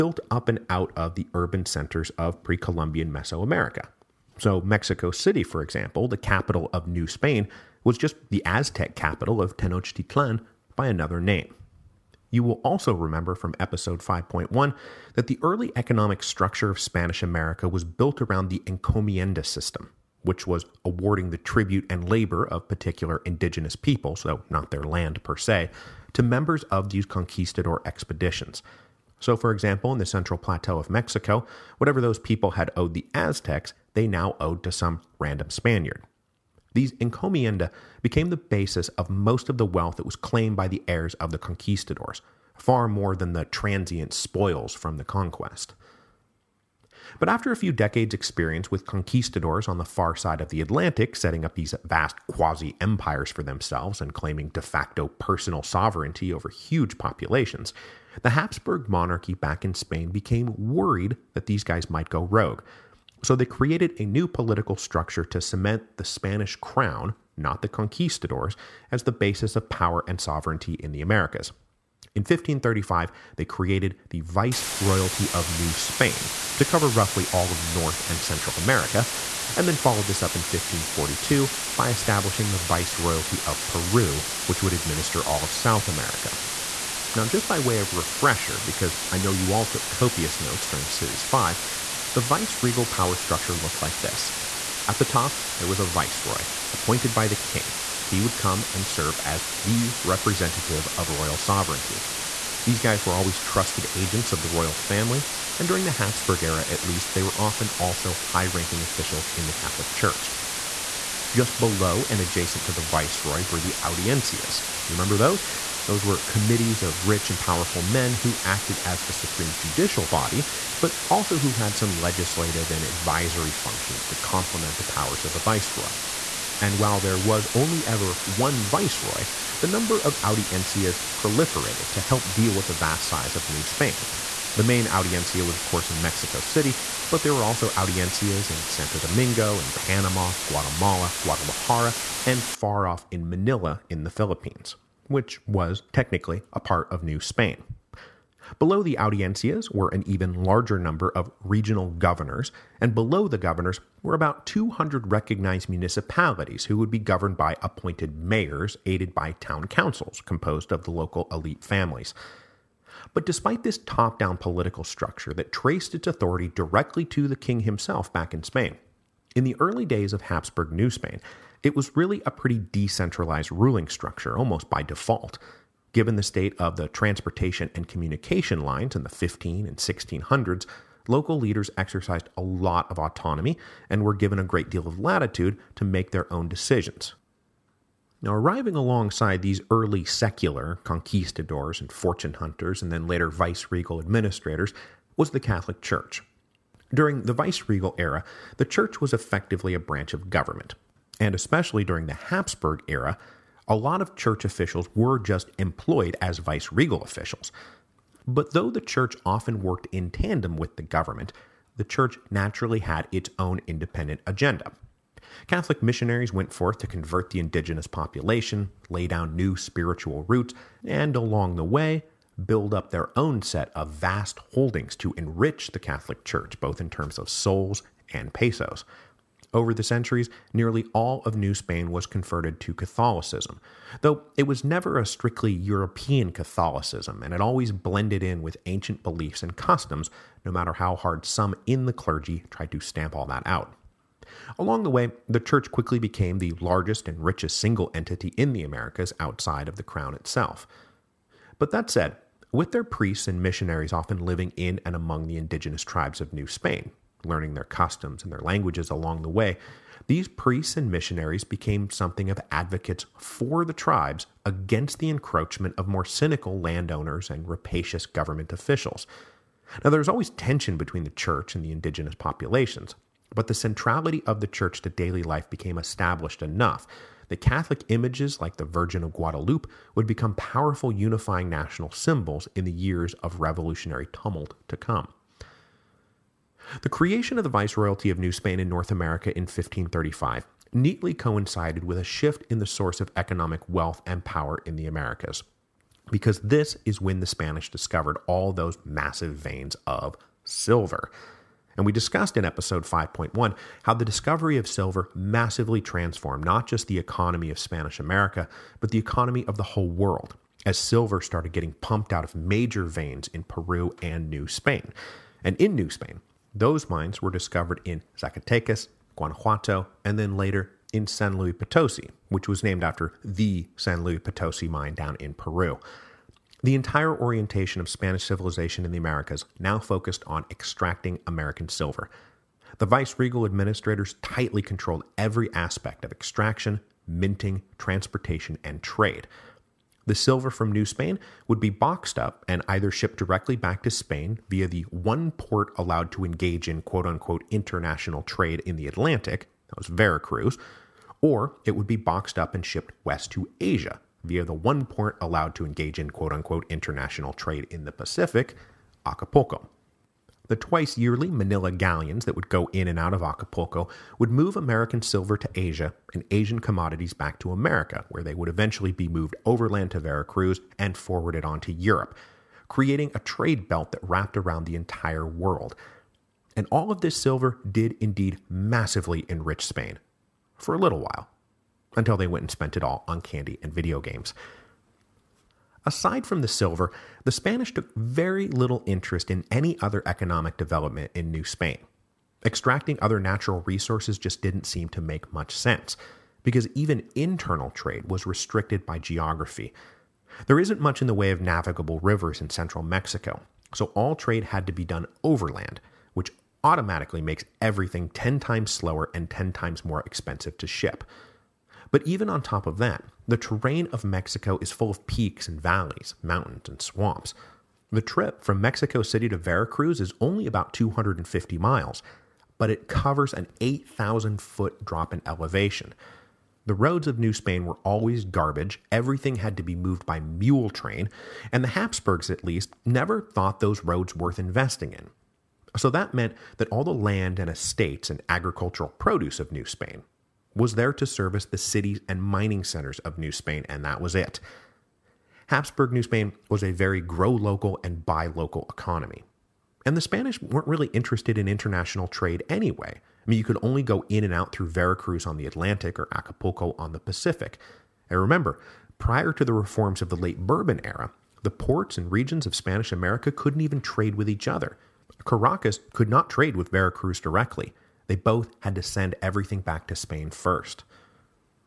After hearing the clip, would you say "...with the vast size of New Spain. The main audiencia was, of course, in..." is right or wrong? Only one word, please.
right.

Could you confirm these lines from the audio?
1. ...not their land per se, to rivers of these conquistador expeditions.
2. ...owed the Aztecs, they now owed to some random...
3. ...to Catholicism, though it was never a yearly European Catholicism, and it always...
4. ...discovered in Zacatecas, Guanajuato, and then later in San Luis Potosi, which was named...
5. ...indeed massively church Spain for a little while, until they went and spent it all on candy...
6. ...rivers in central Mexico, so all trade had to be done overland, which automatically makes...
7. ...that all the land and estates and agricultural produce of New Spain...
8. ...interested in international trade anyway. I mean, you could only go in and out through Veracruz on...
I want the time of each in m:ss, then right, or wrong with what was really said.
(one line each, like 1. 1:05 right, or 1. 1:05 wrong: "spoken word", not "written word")
1. 0:24 wrong: "members", not "rivers"
2. 0:32 right
3. 3:52 wrong: "strictly", not "yearly"
4. 5:17 right
5. 6:17 wrong: "enrich", not "church"
6. 6:42 right
7. 7:16 right
8. 7:30 right.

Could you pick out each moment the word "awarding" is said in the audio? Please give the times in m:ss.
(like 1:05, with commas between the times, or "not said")
0:20.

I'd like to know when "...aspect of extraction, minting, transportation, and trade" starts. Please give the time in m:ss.
5:35.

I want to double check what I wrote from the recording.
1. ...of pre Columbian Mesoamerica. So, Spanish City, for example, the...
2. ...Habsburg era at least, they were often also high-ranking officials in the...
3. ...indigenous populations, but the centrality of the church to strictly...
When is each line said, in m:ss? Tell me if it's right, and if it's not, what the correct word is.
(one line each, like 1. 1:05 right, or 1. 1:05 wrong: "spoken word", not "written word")
1. 0:02 wrong: "Mexico", not "Spanish"
2. 1:45 right
3. 4:31 wrong: "daily", not "strictly".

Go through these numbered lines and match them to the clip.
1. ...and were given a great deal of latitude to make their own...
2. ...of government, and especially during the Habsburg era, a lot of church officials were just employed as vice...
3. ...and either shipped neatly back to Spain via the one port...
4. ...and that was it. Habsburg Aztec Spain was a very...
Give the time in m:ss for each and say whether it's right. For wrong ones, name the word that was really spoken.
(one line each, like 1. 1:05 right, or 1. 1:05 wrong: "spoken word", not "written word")
1. 3:03 right
2. 3:20 right
3. 5:42 wrong: "directly", not "neatly"
4. 7:23 wrong: "New", not "Aztec".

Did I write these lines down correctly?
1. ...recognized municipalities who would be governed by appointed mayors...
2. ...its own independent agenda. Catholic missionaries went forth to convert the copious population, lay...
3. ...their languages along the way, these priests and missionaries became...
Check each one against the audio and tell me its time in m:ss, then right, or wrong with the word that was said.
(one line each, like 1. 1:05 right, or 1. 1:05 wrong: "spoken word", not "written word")
1. 2:35 right
2. 3:33 wrong: "indigenous", not "copious"
3. 4:18 right.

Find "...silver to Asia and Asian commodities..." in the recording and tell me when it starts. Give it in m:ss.
6:05.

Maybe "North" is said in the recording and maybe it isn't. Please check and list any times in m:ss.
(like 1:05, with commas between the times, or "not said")
1:17, 4:48.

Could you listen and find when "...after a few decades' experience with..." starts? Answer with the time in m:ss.
0:47.